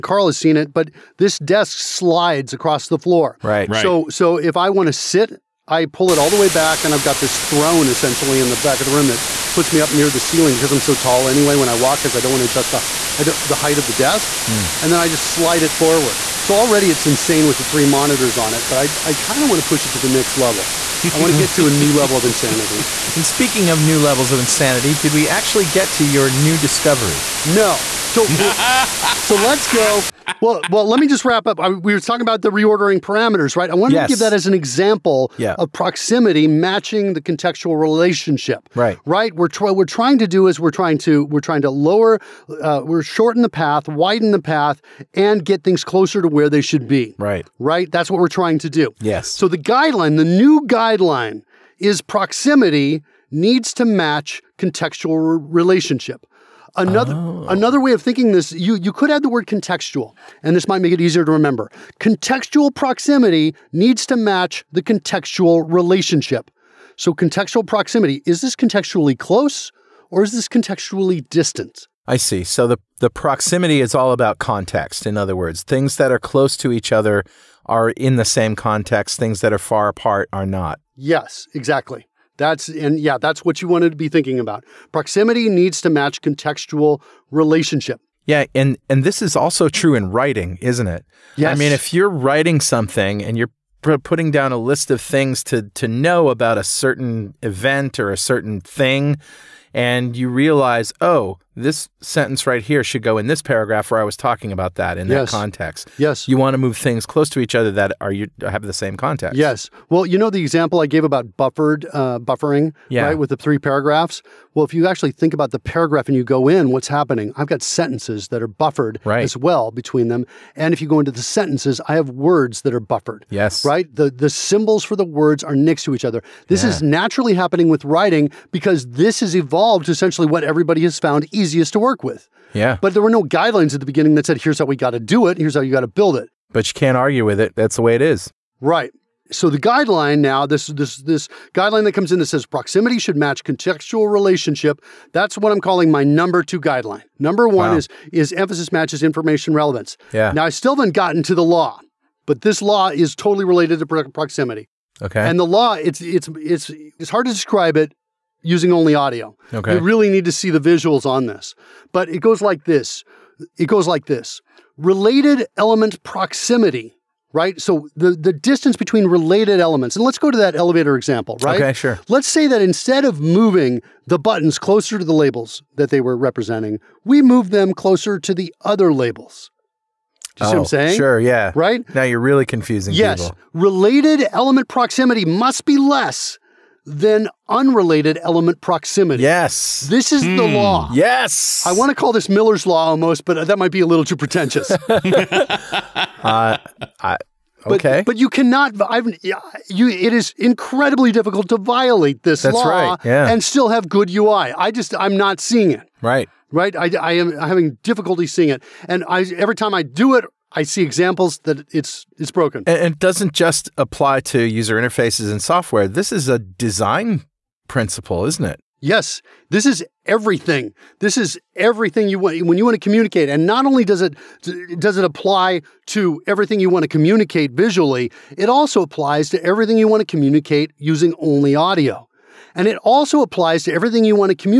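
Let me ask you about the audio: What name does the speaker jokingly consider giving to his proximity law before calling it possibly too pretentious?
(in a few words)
Miller's law.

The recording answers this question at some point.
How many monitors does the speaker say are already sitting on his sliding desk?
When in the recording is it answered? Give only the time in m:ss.
0:17.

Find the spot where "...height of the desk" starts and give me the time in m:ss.
0:13.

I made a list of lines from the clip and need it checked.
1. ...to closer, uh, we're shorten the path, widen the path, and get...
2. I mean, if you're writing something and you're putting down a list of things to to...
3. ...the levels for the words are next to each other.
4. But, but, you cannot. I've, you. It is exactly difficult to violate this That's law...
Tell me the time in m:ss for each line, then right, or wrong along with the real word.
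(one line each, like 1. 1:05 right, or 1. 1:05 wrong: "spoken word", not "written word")
1. 0:41 wrong: "lower", not "closer"
2. 1:31 right
3. 2:04 wrong: "symbols", not "levels"
4. 3:18 wrong: "incredibly", not "exactly".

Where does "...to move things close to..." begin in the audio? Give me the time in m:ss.
1:46.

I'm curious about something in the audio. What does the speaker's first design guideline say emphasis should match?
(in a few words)
Information relevance.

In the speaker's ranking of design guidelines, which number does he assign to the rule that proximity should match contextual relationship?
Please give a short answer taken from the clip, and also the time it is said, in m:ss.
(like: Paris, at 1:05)
2, at 2:26.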